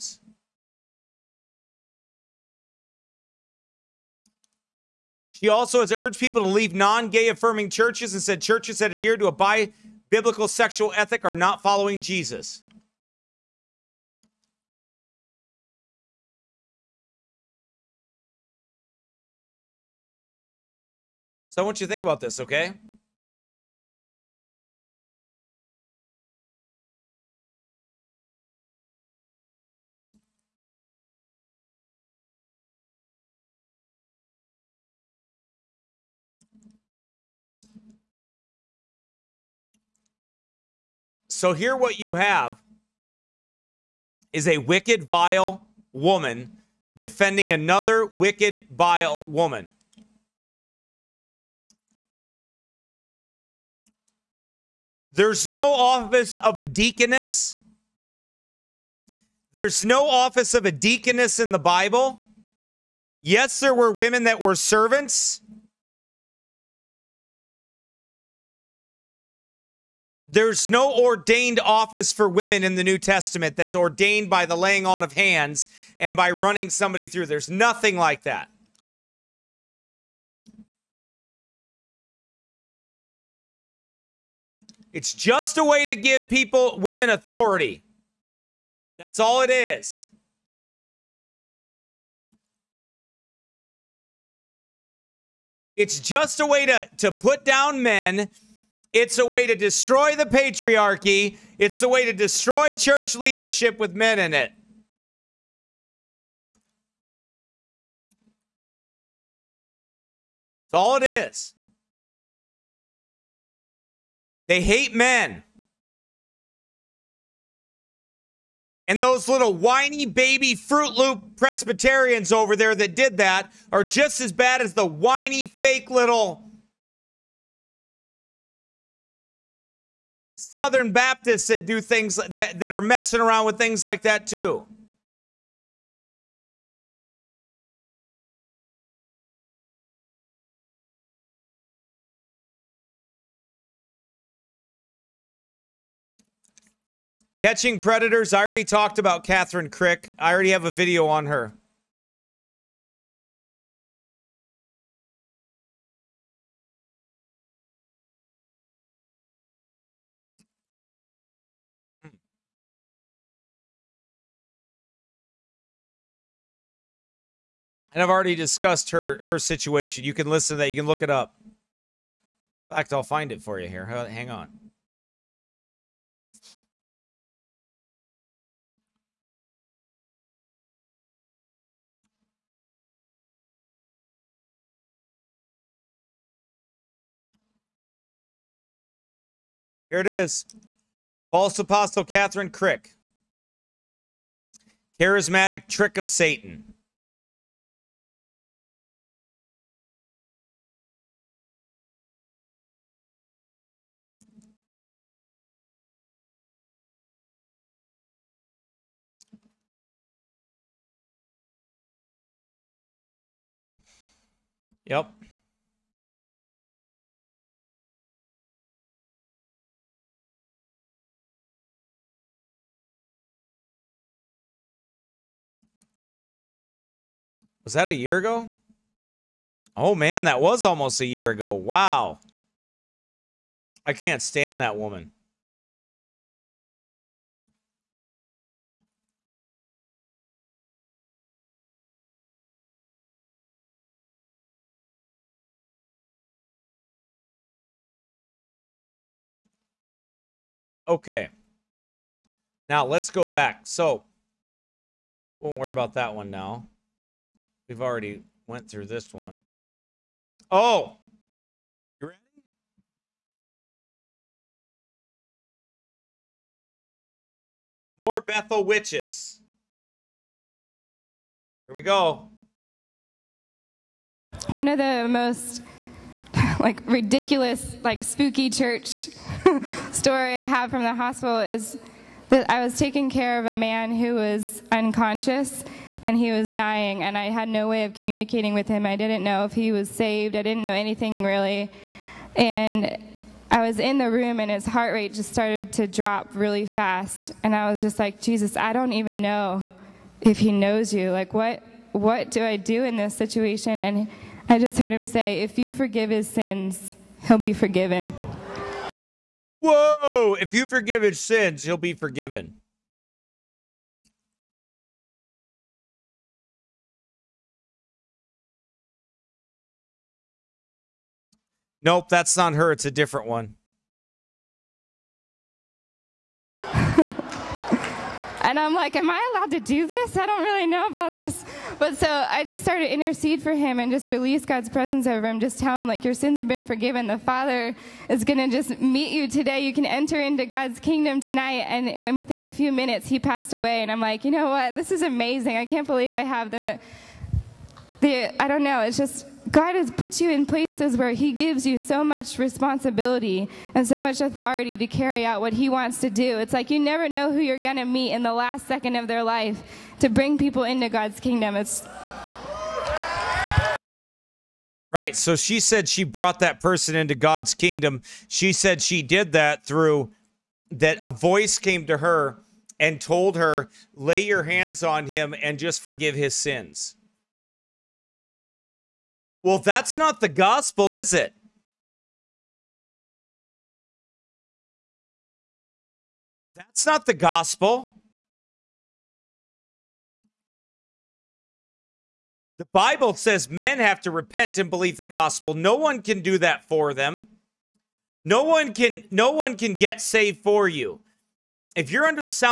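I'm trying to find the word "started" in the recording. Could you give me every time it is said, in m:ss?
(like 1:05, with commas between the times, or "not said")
4:55, 5:32.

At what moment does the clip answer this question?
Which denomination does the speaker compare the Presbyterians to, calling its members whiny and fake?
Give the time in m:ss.
2:10.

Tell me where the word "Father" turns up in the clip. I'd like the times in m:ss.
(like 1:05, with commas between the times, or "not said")
5:37.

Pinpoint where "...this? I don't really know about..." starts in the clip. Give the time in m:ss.
5:29.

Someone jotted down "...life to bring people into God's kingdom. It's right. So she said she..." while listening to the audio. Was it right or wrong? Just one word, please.
right.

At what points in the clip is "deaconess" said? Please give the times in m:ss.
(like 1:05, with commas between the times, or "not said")
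0:56, 1:00.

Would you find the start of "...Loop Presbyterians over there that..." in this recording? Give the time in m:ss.
2:00.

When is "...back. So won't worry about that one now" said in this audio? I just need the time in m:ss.
4:13.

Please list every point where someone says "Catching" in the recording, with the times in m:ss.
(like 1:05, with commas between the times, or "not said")
2:27.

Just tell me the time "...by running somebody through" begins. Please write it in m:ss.
1:16.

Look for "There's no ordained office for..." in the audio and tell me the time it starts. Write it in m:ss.
1:10.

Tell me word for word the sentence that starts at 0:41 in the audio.
So here what you have is a wicked, vile woman defending another wicked, vile woman.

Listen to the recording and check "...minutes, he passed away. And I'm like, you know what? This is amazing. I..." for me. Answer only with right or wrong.
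right.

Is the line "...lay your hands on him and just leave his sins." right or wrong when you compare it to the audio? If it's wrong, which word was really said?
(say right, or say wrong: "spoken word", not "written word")
wrong: "forgive", not "leave".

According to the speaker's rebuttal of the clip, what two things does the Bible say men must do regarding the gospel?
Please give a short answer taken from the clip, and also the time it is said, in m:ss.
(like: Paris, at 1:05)
Repent and believe, at 6:34.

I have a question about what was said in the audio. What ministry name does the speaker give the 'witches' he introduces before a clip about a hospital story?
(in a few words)
Bethel.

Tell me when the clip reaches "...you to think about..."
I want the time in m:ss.
0:21.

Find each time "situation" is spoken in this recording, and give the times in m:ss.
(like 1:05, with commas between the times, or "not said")
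2:49, 5:03.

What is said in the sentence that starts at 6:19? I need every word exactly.
Well, that's not the gospel, is it?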